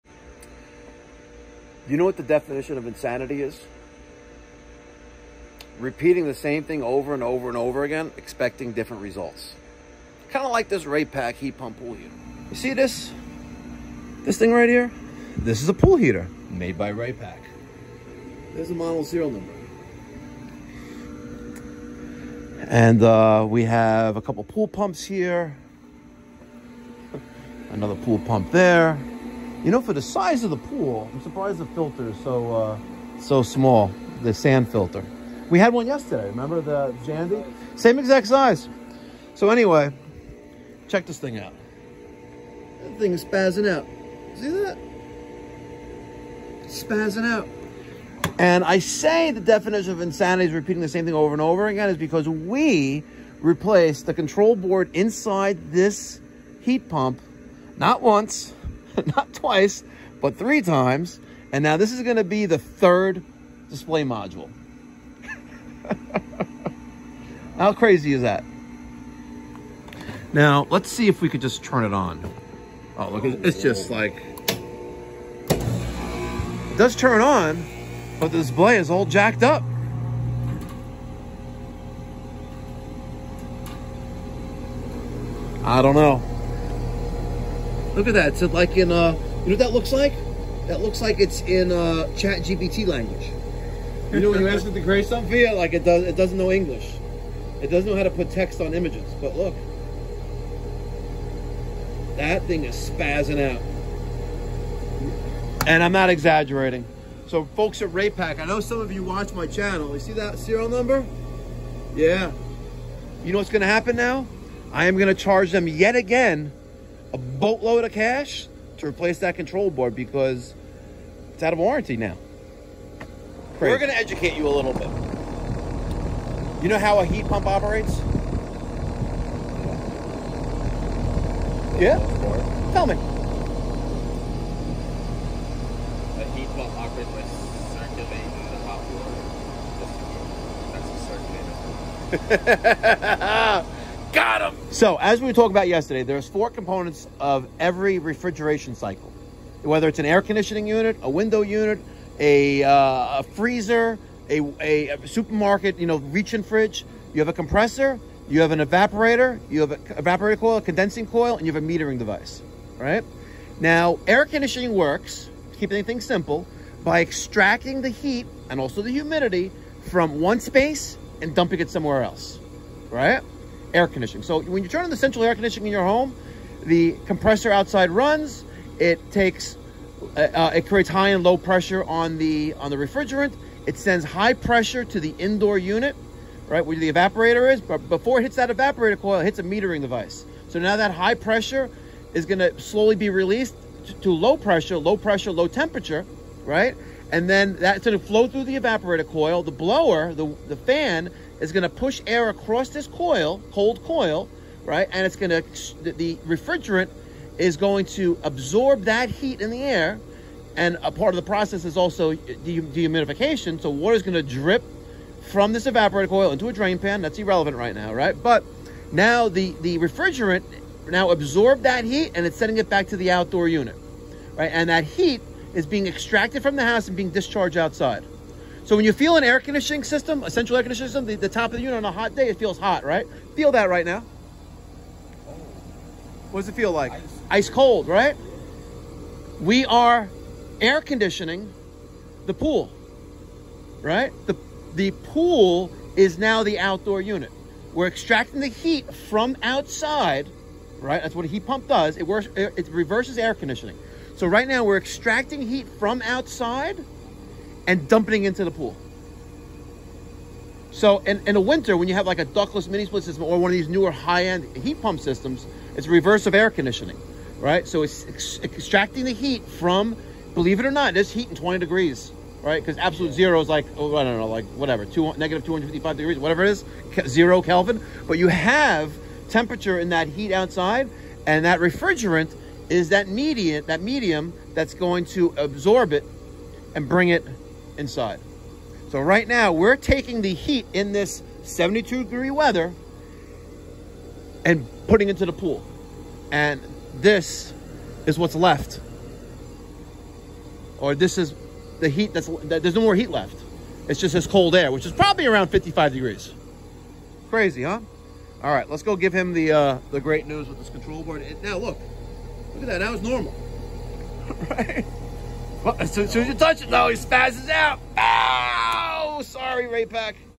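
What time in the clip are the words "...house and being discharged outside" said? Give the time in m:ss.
3:46.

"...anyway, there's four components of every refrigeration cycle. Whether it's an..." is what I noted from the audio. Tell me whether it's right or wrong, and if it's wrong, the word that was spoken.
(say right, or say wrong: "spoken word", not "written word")
wrong: "yesterday", not "anyway".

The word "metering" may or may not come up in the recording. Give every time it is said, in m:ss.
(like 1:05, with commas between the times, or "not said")
2:41, 3:09.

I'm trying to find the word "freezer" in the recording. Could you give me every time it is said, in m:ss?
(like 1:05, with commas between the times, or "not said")
2:33.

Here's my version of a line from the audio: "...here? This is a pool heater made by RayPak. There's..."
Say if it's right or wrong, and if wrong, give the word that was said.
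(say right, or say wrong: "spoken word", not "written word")
right.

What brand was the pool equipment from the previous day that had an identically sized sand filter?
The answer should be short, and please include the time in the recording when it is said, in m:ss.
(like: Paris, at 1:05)
Jandy, at 0:37.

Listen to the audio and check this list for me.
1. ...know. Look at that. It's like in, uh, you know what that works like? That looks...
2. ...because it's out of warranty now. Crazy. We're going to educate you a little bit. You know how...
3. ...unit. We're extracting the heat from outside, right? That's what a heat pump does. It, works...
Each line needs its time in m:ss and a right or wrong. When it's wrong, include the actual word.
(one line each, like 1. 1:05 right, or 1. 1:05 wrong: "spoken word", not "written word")
1. 1:25 wrong: "looks", not "works"
2. 1:59 right
3. 4:07 right.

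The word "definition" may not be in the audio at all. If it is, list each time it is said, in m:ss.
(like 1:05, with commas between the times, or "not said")
0:02, 0:49.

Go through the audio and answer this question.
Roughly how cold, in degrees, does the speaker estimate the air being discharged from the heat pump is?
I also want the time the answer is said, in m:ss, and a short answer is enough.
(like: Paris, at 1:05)
55 degrees, at 5:05.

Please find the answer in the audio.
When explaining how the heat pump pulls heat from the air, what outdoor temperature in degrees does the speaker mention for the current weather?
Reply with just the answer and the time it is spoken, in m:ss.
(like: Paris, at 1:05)
72 degrees, at 4:51.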